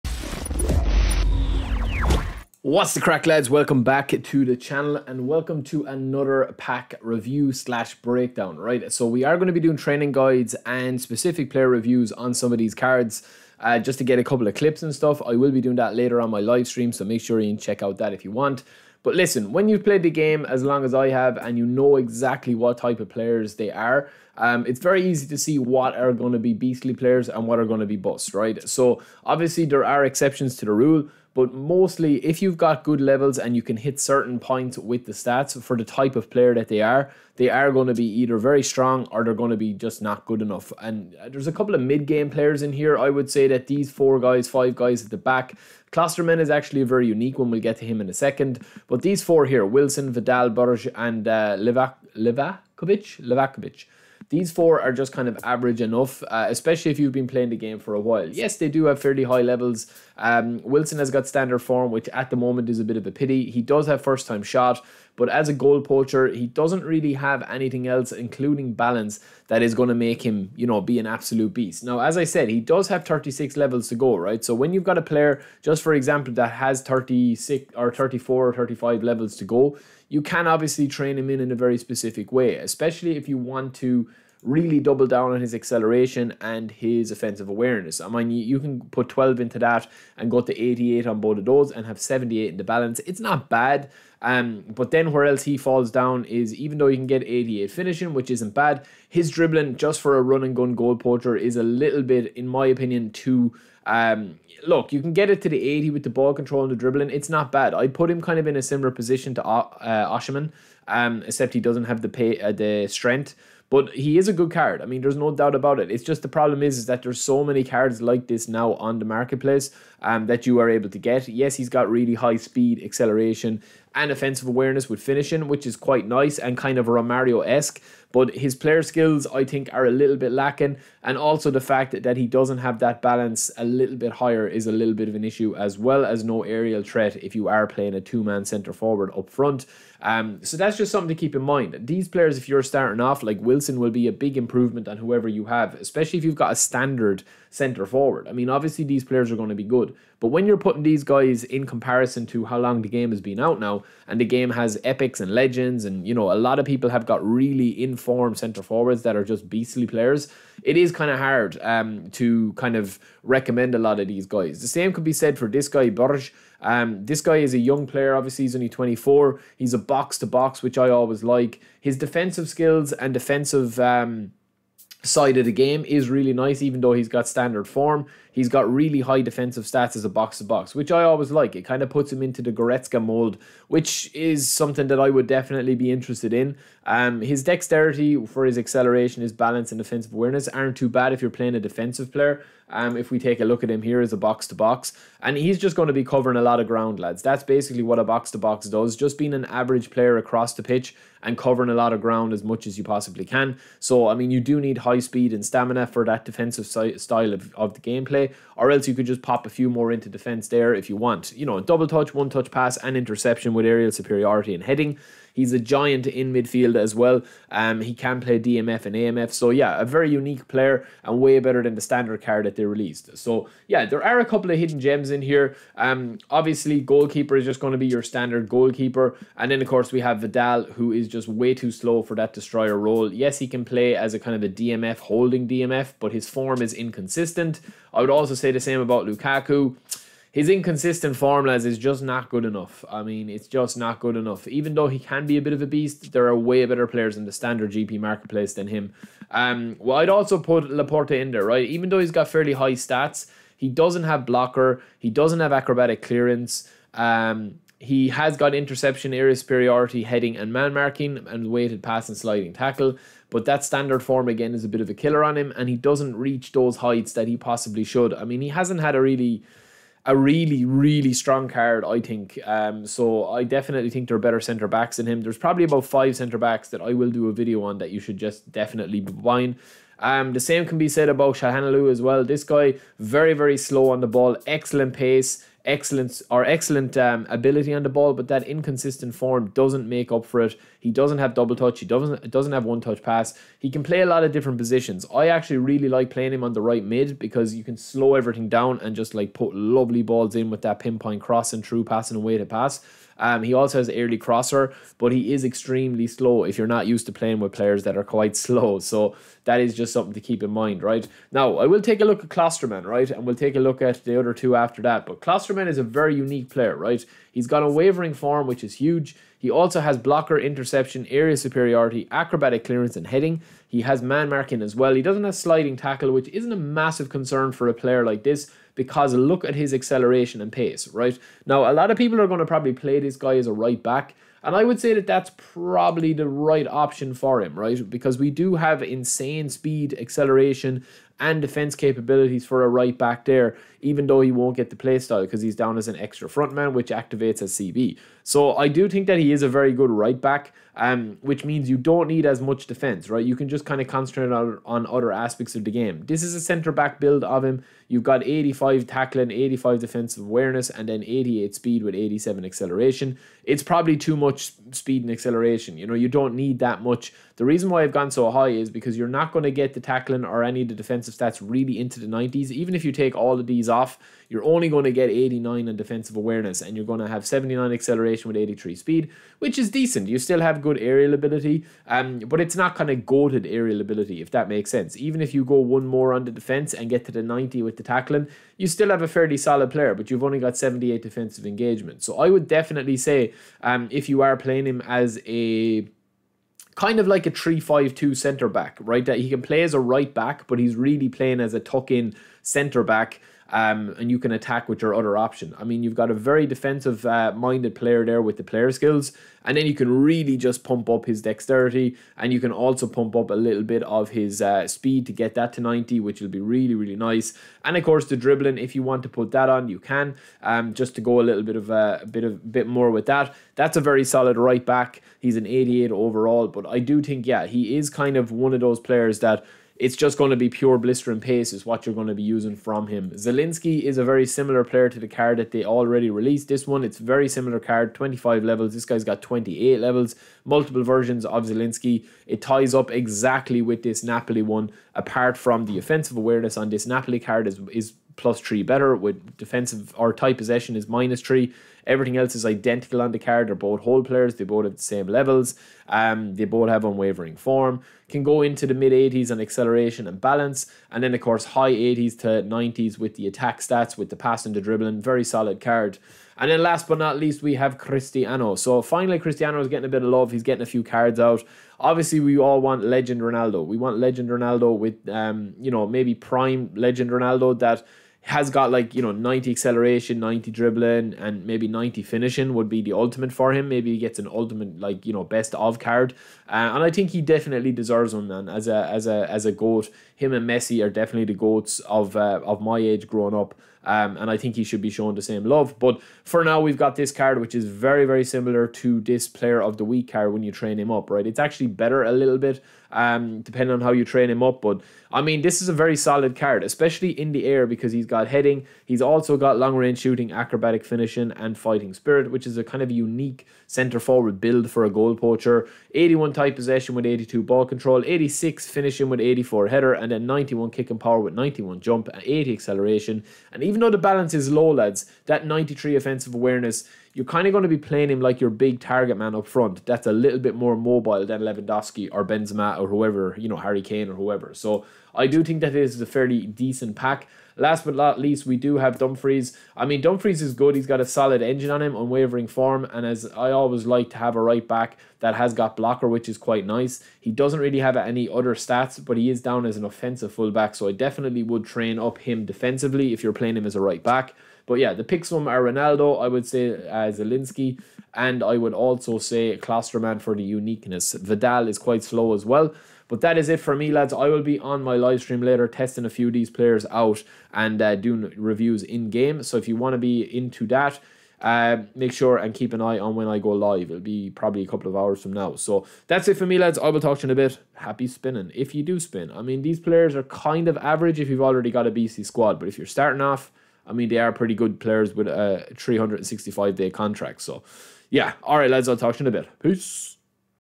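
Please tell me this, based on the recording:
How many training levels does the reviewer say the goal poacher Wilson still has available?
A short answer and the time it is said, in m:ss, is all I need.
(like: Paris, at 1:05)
36, at 1:13.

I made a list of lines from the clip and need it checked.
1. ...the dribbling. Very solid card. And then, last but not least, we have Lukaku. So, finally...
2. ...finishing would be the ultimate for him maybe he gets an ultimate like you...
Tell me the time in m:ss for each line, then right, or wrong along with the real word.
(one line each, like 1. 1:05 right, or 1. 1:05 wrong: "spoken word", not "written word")
1. 7:44 wrong: "Cristiano", not "Lukaku"
2. 8:02 right.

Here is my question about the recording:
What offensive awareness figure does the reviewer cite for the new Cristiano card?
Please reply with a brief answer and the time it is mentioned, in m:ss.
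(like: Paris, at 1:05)
93, at 8:45.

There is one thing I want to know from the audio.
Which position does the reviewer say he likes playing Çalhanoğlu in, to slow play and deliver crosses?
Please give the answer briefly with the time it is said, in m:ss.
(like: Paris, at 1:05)
right mid, at 4:56.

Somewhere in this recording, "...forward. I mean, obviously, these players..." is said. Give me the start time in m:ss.
2:27.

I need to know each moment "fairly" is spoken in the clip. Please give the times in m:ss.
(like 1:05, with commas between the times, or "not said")
0:58, 4:12, 6:29, 8:56.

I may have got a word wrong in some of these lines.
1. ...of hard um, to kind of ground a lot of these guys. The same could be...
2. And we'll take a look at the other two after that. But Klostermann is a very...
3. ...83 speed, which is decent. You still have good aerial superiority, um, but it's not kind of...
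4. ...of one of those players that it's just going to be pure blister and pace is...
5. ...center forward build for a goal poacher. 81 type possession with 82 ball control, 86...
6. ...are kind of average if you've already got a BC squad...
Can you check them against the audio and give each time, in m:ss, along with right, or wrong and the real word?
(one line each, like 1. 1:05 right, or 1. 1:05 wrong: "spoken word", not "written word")
1. 2:41 wrong: "recommend", not "ground"
2. 5:13 right
3. 6:18 wrong: "ability", not "superiority"
4. 7:08 right
5. 8:33 right
6. 9:40 right.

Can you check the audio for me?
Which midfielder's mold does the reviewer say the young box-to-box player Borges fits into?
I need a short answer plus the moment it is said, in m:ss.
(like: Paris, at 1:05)
Goretzka, at 3:02.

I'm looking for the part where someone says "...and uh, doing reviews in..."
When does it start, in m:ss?
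9:27.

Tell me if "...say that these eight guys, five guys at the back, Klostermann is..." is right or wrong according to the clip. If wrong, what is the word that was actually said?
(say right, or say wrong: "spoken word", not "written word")
wrong: "four", not "eight".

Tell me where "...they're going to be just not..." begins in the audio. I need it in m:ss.
0:39.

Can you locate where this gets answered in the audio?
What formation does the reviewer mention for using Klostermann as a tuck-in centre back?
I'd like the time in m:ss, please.
6:37.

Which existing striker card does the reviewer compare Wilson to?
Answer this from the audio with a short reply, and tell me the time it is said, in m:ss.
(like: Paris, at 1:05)
Osherman, at 1:50.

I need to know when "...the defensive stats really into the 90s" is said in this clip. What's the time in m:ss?
6:10.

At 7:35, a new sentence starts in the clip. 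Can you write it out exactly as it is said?
Um, they both have unwavering form.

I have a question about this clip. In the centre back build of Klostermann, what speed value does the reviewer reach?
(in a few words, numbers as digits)
88.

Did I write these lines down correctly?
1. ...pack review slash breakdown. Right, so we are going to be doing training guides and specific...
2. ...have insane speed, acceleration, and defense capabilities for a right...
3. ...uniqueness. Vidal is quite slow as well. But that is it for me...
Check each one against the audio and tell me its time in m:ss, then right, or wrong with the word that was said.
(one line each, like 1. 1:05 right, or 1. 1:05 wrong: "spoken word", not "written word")
1. 0:06 right
2. 5:38 right
3. 9:20 right.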